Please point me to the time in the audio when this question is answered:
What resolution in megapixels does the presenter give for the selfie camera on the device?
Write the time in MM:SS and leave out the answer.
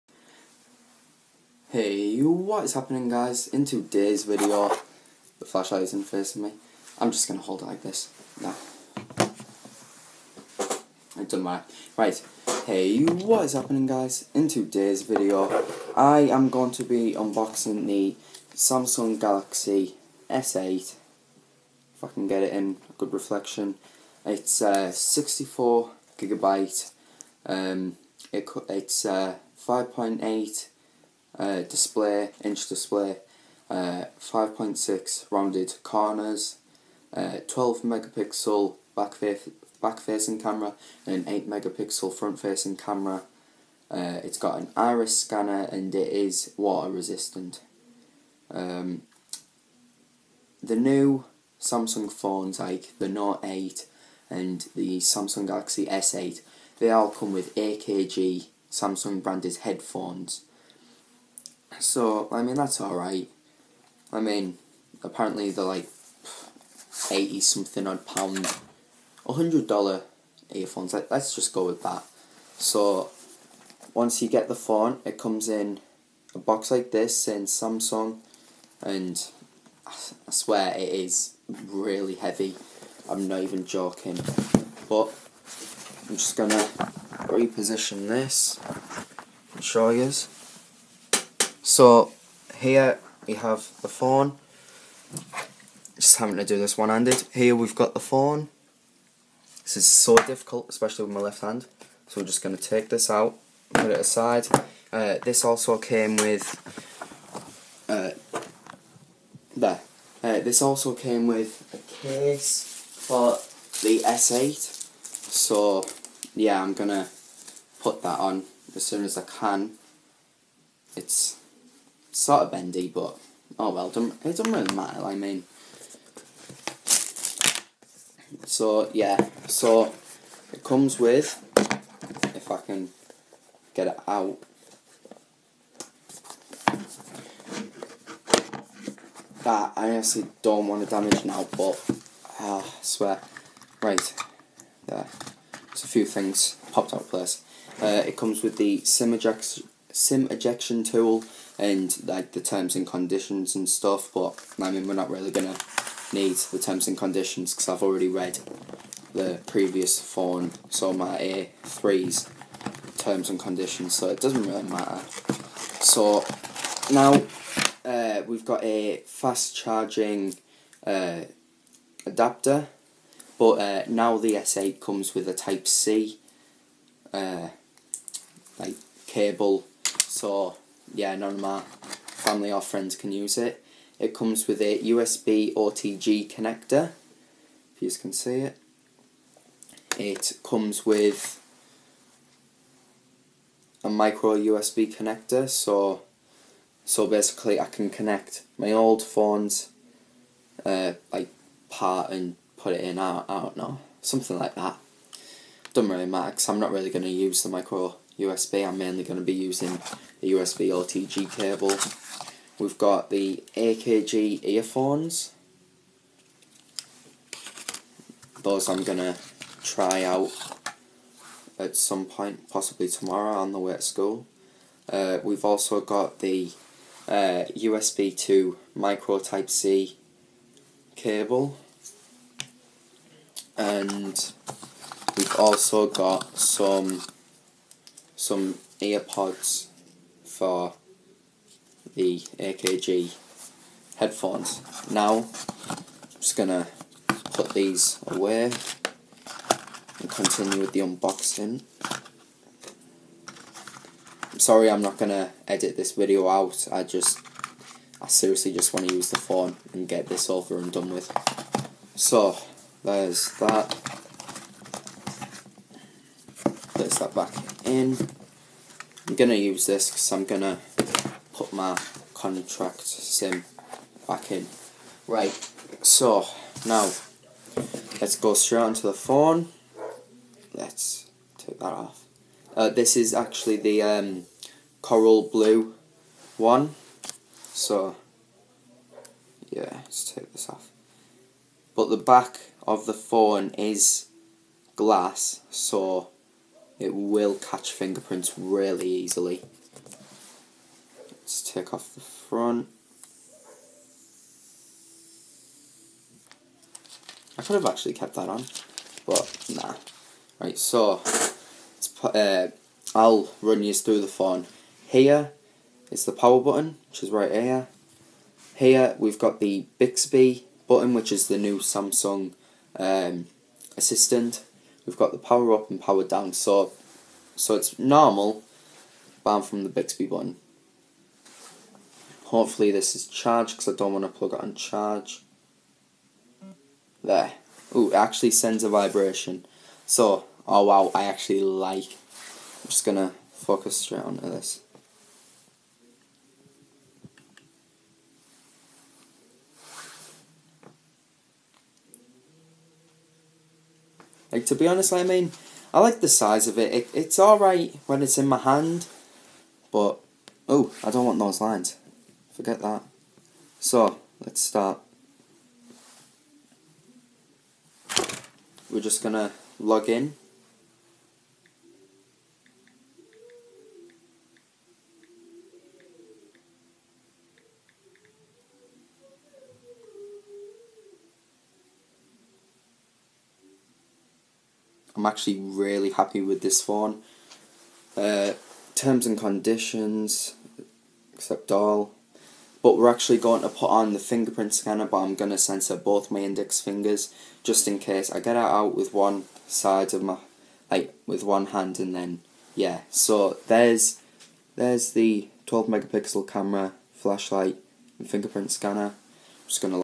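00:41.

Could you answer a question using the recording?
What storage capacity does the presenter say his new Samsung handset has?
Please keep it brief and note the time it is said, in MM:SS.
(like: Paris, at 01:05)
64 gigabyte, at 00:24.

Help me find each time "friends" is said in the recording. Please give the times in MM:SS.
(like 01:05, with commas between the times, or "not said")
03:02.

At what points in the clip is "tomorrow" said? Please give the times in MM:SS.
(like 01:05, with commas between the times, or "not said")
03:42.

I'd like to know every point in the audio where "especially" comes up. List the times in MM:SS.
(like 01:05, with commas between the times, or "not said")
01:40.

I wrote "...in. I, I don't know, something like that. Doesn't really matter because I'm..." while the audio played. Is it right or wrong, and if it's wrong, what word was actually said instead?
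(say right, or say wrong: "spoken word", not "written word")
right.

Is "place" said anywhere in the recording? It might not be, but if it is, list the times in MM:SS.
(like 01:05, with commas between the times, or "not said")
02:27, 04:26.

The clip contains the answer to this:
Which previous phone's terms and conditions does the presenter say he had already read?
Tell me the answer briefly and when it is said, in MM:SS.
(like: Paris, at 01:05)
A3, at 02:41.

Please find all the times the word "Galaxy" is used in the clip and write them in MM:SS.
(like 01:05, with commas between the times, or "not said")
00:19, 00:55.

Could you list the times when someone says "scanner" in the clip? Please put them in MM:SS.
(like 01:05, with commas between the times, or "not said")
00:45, 06:34, 06:48.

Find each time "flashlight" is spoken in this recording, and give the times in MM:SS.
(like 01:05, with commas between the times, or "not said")
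00:05, 06:46.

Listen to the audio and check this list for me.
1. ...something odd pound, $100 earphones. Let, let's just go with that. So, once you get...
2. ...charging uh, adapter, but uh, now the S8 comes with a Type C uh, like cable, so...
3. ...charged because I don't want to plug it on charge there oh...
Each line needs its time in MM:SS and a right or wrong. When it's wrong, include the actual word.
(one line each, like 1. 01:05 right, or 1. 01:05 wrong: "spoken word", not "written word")
1. 01:07 right
2. 02:49 right
3. 05:33 right.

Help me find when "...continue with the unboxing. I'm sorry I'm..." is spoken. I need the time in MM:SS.
04:10.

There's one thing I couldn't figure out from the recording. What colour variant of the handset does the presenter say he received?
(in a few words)
Coral blue.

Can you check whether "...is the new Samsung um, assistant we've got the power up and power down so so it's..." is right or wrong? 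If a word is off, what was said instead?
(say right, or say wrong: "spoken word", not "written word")
right.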